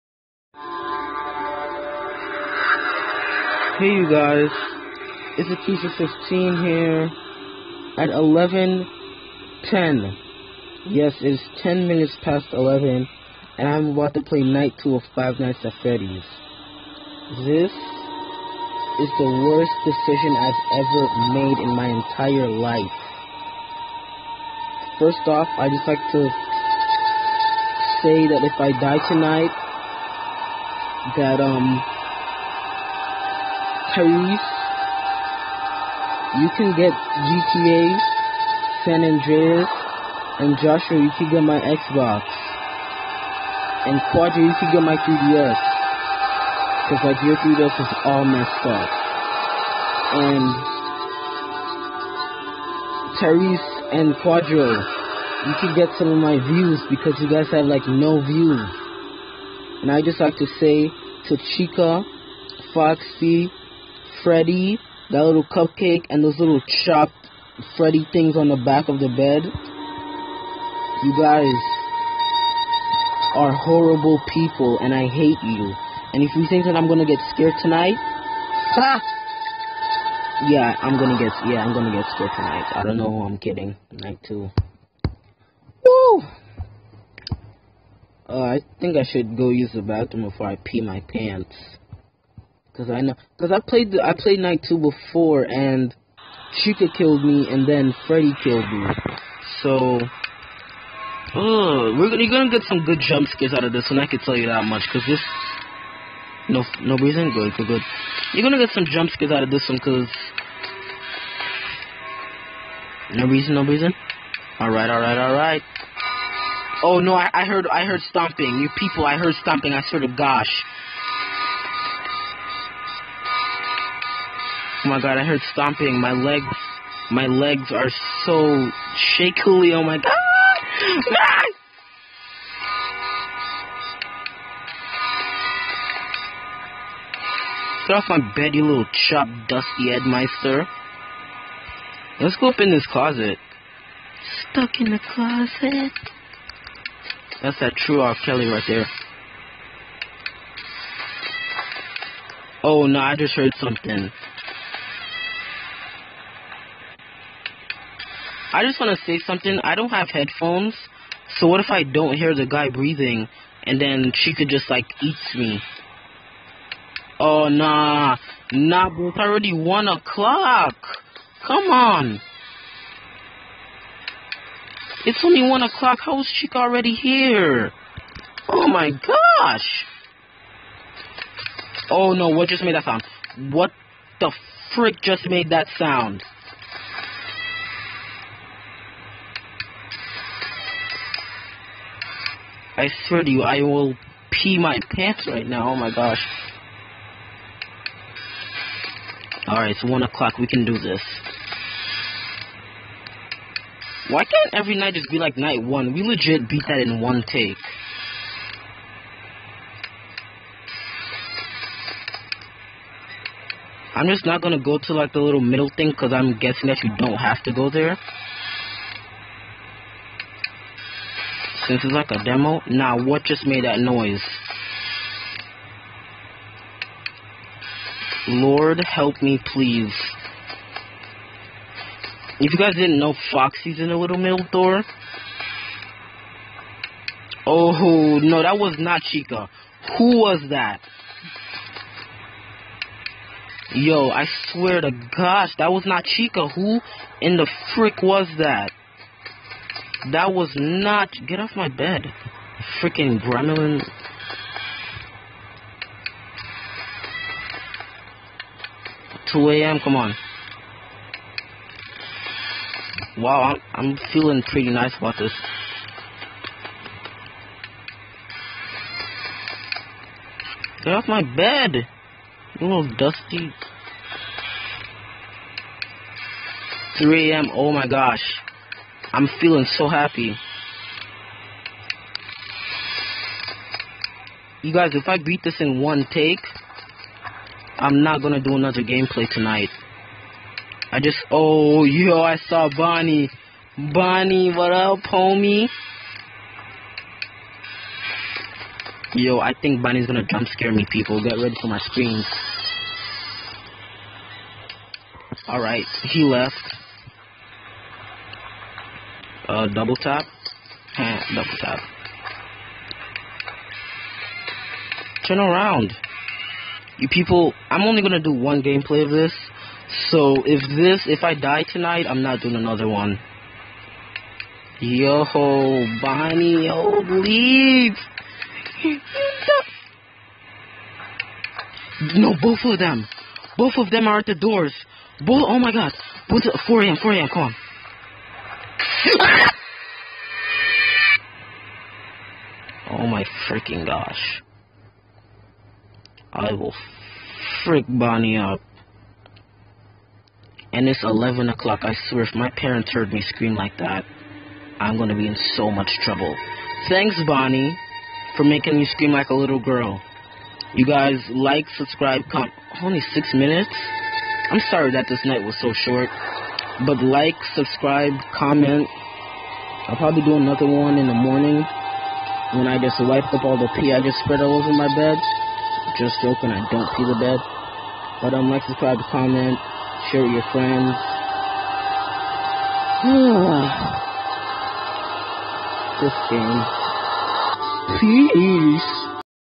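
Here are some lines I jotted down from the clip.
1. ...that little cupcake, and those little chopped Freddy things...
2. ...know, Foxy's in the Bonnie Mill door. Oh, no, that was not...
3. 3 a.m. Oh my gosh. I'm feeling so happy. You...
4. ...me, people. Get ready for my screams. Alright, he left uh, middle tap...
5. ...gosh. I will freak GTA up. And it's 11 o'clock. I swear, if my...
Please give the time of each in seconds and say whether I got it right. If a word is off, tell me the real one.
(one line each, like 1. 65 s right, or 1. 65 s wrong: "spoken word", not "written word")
1. 65 s right
2. 232 s wrong: "Little", not "Bonnie"
3. 277 s right
4. 300 s wrong: "double", not "middle"
5. 343 s wrong: "Bonnie", not "GTA".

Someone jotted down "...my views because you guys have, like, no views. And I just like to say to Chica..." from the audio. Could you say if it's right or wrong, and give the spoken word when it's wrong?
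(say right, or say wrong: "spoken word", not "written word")
right.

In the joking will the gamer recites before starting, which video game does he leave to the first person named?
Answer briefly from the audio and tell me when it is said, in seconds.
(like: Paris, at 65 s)
GTA San Andreas, at 36 s.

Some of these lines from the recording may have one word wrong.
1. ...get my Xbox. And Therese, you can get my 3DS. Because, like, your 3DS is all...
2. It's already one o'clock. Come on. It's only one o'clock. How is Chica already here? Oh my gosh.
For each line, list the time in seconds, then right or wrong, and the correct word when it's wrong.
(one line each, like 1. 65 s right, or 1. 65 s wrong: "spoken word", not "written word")
1. 41 s wrong: "Quadra", not "Therese"
2. 169 s right.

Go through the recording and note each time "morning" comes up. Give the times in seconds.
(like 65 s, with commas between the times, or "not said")
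371 s.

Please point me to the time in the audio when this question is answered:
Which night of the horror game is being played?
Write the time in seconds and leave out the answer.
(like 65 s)
14 s.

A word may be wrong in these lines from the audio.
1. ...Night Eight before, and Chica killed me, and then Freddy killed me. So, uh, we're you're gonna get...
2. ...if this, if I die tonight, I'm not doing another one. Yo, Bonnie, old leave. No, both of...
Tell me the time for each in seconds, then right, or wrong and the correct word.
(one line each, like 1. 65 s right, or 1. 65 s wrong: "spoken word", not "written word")
1. 94 s wrong: "Two", not "Eight"
2. 320 s right.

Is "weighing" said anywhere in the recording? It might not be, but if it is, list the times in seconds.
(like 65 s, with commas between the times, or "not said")
not said.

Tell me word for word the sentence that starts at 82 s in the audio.
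I don't know who I'm kidding.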